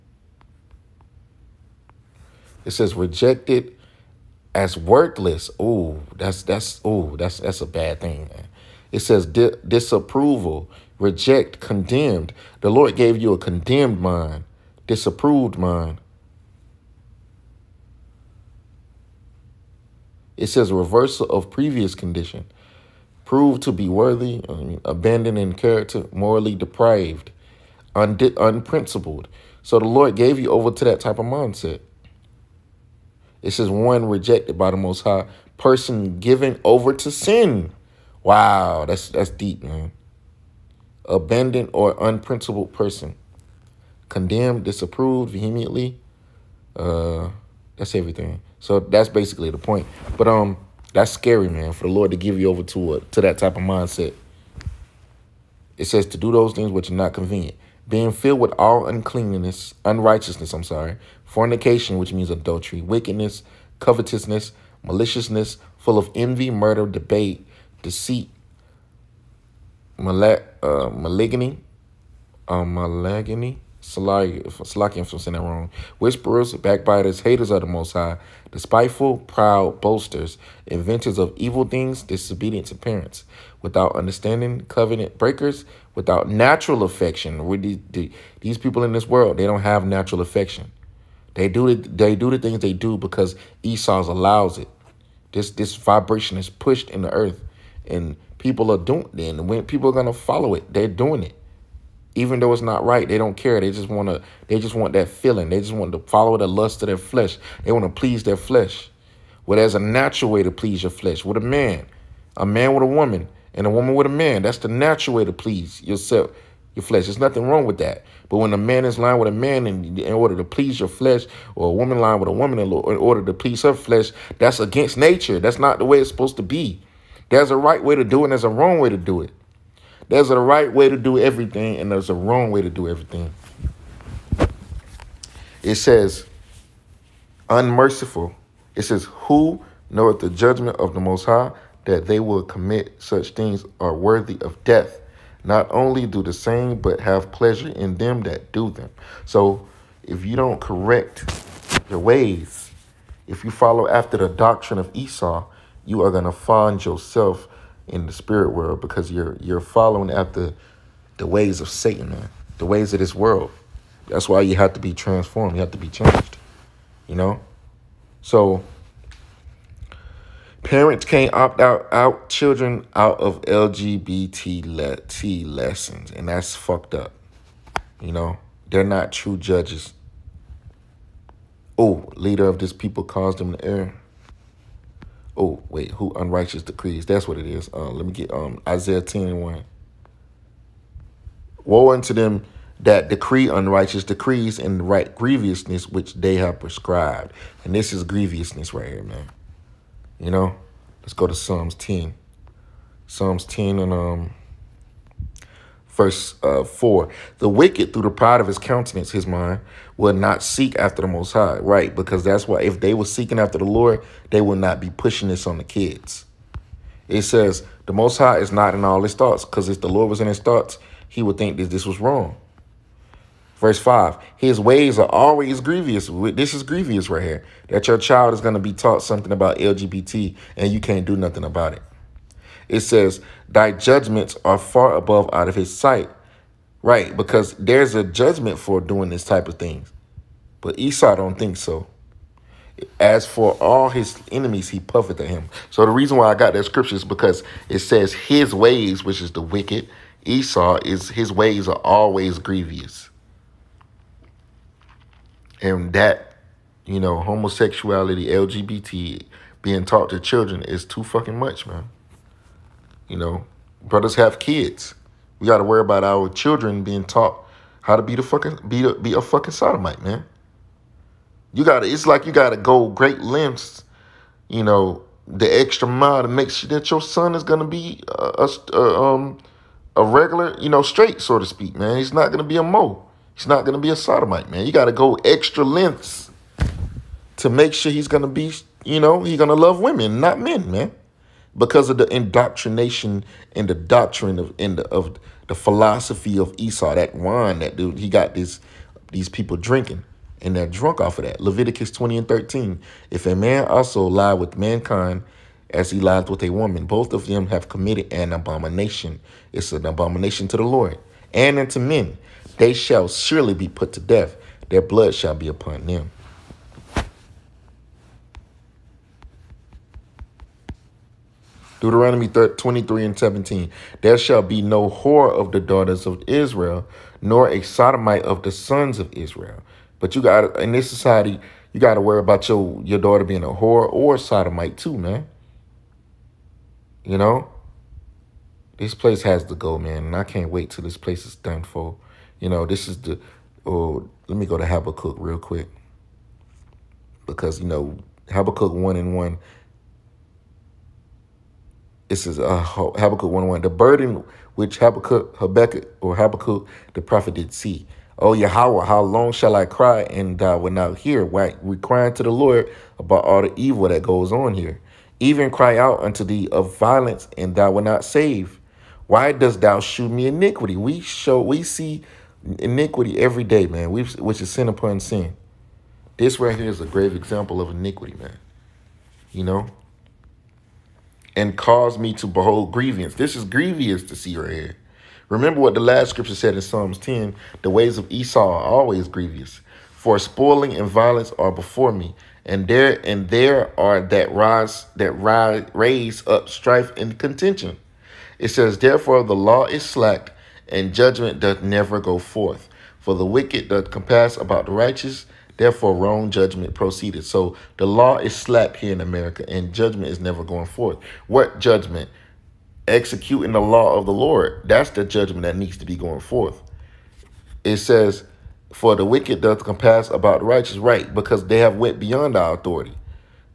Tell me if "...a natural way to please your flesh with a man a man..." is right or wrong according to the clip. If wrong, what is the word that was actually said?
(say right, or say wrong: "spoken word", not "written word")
right.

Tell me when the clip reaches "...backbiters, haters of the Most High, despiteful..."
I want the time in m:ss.
1:16.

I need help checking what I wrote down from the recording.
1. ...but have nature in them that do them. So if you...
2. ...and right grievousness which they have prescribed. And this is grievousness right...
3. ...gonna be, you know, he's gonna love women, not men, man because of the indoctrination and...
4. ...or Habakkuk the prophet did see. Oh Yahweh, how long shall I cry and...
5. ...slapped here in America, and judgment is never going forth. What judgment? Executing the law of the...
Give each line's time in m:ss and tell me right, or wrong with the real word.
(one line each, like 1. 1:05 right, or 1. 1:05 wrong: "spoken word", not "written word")
1. 2:26 wrong: "pleasure", not "nature"
2. 3:14 right
3. 4:48 right
4. 5:56 right
5. 6:48 right.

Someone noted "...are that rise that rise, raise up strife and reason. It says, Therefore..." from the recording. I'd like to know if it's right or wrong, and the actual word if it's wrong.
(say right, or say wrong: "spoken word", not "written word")
wrong: "contention", not "reason".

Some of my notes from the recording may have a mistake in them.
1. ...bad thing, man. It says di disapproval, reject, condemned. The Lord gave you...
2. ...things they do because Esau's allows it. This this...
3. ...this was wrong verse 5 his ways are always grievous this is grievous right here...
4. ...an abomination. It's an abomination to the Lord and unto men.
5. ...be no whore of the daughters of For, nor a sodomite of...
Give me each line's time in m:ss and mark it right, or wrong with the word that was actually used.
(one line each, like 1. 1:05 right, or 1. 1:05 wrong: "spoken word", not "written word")
1. 0:07 right
2. 1:32 right
3. 3:41 right
4. 5:08 right
5. 5:24 wrong: "Israel", not "For".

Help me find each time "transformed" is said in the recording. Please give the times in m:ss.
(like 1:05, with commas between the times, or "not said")
2:44.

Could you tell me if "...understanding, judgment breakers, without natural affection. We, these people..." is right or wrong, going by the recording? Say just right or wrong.
wrong.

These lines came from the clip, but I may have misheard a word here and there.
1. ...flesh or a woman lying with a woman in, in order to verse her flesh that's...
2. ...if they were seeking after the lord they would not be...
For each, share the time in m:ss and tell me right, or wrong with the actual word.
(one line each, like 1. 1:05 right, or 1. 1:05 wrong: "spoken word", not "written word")
1. 2:00 wrong: "please", not "verse"
2. 3:32 right.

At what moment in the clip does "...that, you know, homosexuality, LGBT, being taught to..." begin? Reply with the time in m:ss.
4:15.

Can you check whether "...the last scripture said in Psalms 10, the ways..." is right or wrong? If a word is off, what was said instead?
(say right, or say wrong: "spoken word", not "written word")
right.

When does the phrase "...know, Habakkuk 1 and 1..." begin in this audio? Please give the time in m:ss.
5:47.